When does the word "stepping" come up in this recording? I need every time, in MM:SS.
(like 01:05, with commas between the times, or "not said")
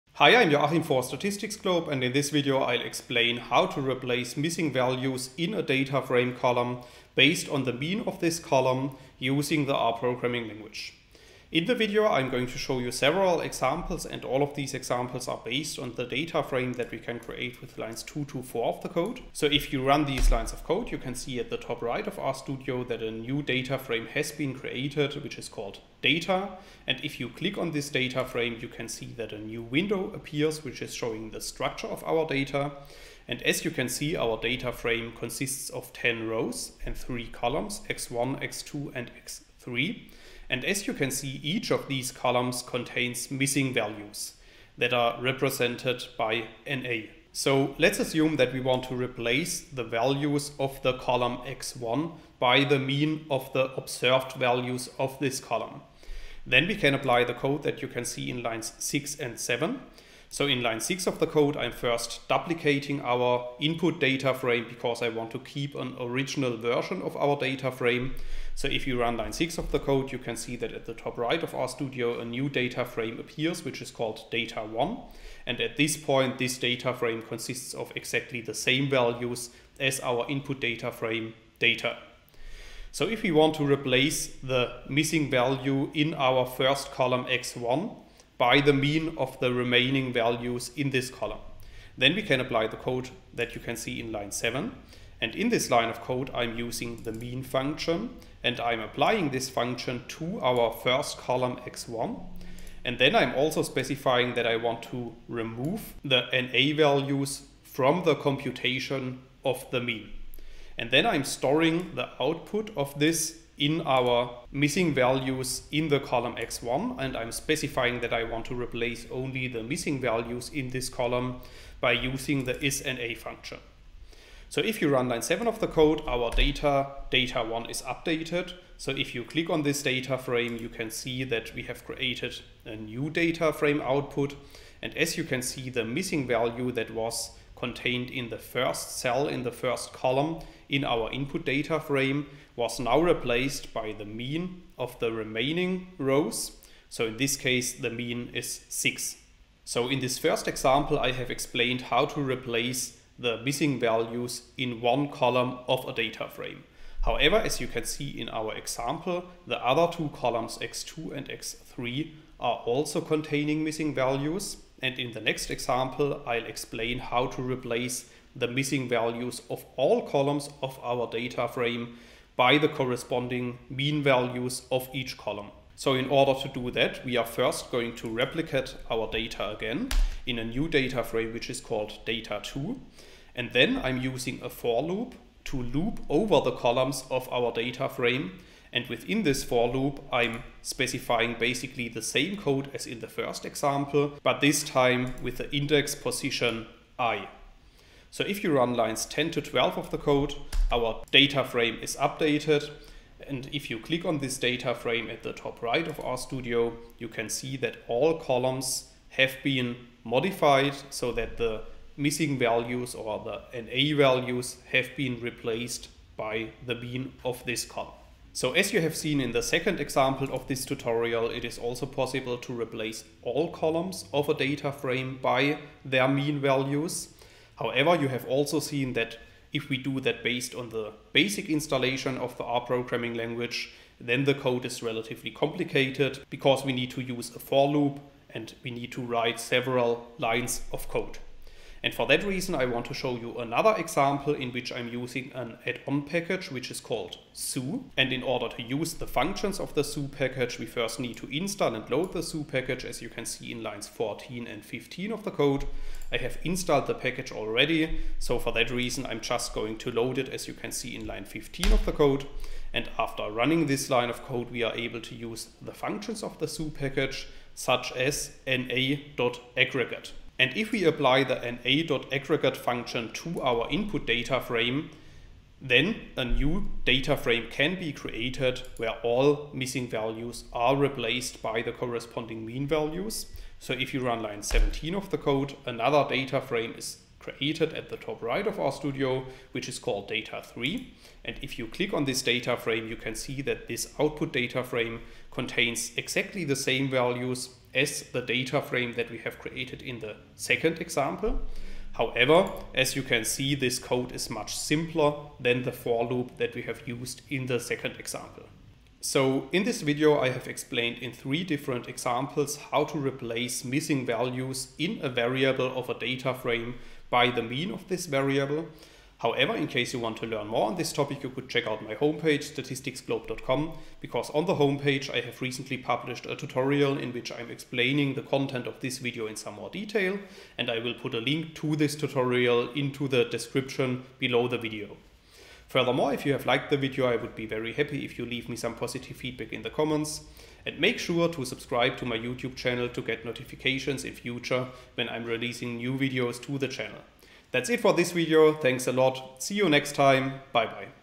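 not said.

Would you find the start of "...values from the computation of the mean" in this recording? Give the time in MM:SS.
01:46.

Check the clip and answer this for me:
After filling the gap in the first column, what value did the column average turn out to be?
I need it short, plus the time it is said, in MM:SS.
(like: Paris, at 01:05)
6, at 02:27.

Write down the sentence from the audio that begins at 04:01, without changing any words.
And for that reason, I want to show you another example in which I'm using an add-on package, which is called zoo.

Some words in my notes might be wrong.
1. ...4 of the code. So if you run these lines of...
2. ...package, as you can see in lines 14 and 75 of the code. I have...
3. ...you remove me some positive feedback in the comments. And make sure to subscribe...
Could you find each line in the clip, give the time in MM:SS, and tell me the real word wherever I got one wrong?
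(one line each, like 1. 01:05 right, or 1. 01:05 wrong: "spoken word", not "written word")
1. 00:18 right
2. 04:12 wrong: "15", not "75"
3. 05:38 wrong: "leave", not "remove".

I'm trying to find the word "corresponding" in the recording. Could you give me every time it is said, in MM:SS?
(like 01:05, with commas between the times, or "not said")
02:52, 04:41.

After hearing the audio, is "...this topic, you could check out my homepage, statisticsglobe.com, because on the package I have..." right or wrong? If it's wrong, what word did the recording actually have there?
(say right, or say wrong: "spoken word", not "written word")
wrong: "homepage", not "package".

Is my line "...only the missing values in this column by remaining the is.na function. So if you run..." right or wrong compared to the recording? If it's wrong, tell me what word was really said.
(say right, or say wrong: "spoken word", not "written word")
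wrong: "using", not "remaining".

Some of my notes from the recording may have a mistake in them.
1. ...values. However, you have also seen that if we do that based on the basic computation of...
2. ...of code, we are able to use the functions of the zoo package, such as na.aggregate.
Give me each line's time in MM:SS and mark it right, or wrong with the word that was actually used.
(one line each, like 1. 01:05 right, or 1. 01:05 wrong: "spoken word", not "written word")
1. 03:46 wrong: "installation", not "computation"
2. 04:24 right.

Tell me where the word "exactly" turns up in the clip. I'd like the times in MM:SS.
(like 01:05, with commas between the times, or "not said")
01:17, 04:55.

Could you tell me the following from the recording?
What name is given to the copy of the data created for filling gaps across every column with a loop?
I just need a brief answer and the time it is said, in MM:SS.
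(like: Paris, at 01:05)
data2, at 03:02.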